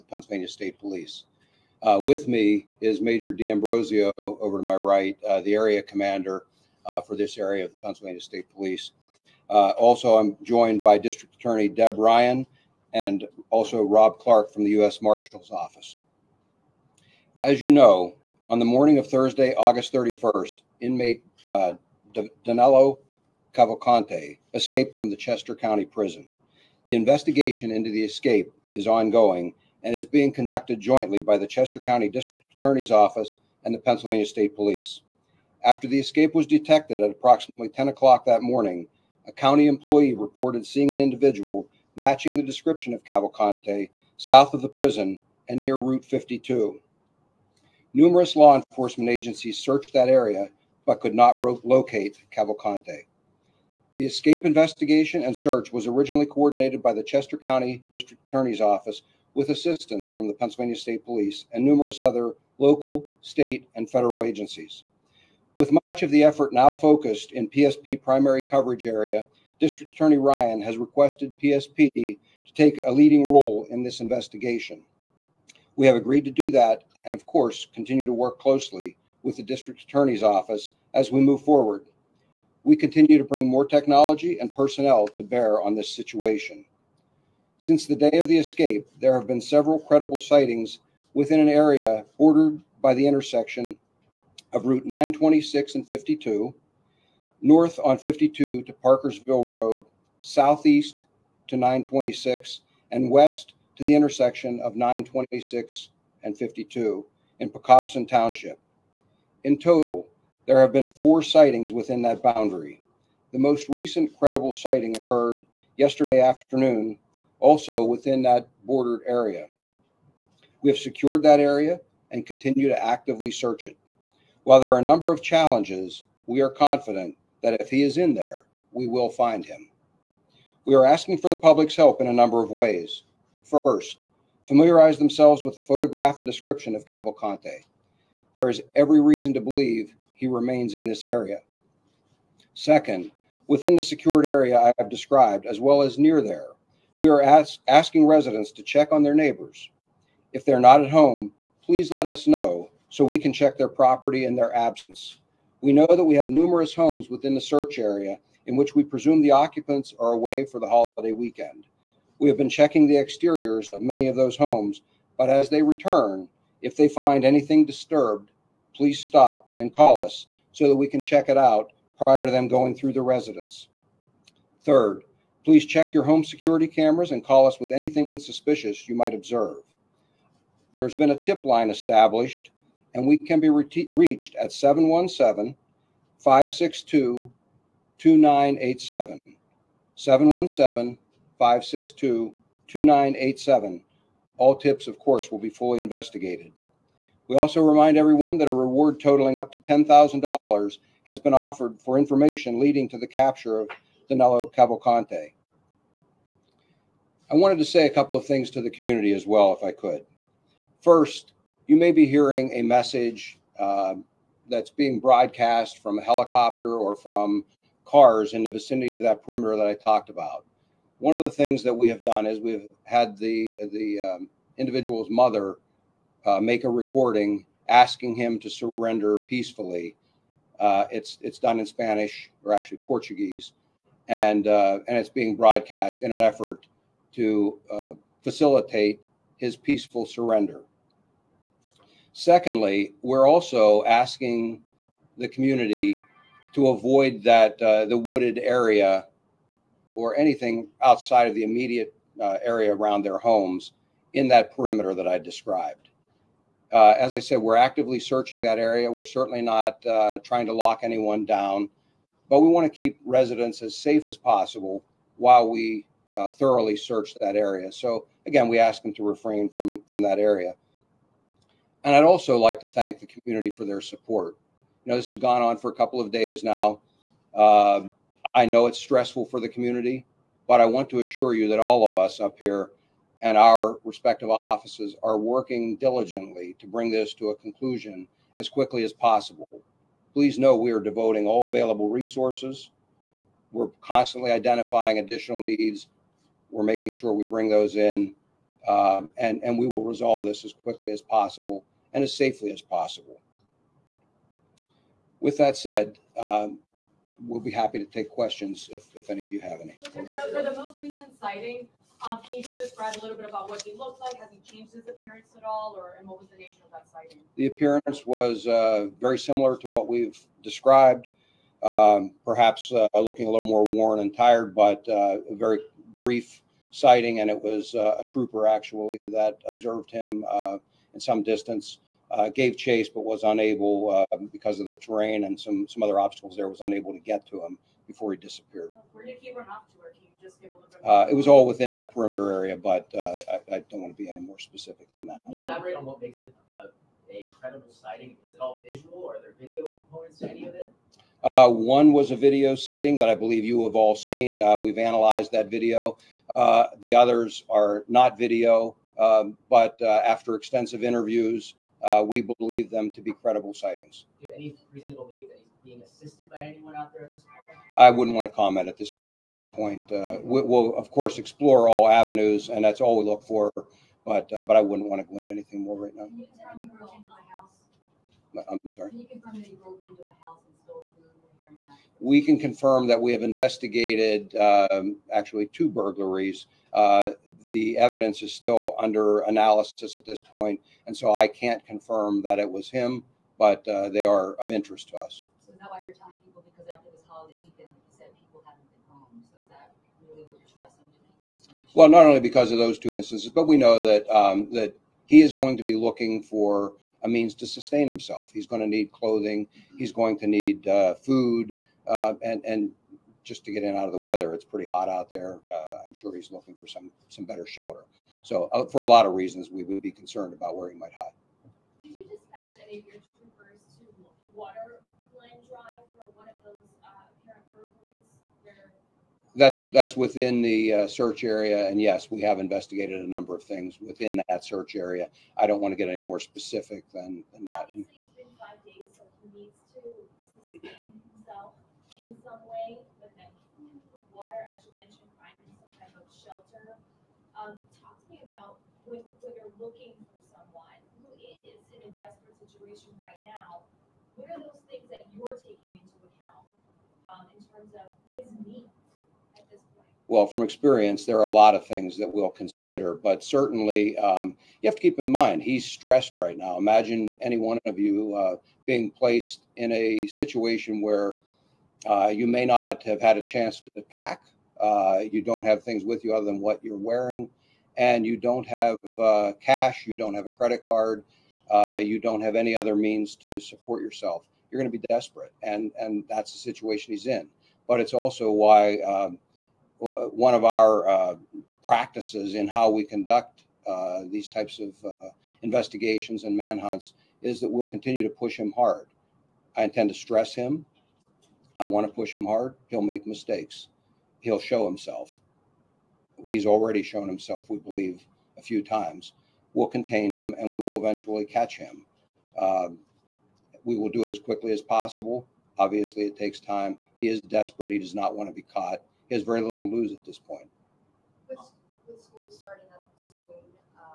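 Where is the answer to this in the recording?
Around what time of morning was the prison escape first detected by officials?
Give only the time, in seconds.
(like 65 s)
37 s.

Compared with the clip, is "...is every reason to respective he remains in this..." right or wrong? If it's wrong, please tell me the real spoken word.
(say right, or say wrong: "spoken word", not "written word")
wrong: "believe", not "respective".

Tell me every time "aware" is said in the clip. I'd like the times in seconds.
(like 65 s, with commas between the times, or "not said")
not said.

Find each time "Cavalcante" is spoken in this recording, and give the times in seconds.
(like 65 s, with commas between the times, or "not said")
23 s, 43 s, 52 s, 136 s, 204 s.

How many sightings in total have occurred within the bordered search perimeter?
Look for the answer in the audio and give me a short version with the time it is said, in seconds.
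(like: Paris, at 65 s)
4, at 110 s.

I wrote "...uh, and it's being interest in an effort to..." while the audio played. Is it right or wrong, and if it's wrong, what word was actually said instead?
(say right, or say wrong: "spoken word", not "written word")
wrong: "broadcast", not "interest".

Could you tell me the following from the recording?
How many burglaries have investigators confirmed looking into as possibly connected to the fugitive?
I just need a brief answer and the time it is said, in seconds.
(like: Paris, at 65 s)
2, at 385 s.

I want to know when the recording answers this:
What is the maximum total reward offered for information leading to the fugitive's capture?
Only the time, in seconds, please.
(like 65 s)
199 s.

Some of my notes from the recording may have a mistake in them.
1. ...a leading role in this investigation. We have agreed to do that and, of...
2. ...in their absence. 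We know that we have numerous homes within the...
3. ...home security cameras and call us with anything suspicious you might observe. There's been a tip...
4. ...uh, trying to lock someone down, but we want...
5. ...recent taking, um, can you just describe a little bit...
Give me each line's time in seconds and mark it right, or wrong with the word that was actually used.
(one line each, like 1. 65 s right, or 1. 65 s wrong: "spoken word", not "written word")
1. 72 s right
2. 154 s right
3. 176 s right
4. 259 s wrong: "anyone", not "someone"
5. 310 s wrong: "sighting", not "taking".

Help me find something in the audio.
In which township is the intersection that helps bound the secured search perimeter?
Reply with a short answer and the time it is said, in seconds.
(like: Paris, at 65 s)
Pocopson Township, at 107 s.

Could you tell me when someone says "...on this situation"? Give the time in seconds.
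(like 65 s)
85 s.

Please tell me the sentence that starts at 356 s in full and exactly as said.
Uh, the others are not video, um, but after extensive interviews, we believe them to be credible sightings.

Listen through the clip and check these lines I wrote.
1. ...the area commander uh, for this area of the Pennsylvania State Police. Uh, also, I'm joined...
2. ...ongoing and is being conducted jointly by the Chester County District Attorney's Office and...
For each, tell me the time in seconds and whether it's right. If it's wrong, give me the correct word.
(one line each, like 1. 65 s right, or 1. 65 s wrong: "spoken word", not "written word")
1. 5 s right
2. 28 s right.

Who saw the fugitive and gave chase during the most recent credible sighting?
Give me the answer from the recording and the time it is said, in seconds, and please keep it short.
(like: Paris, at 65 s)
a trooper, at 327 s.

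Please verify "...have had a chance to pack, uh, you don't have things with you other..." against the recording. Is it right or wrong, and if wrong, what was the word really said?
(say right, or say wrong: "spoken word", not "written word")
right.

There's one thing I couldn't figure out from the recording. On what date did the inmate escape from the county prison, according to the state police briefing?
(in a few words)
Thursday, August 31st.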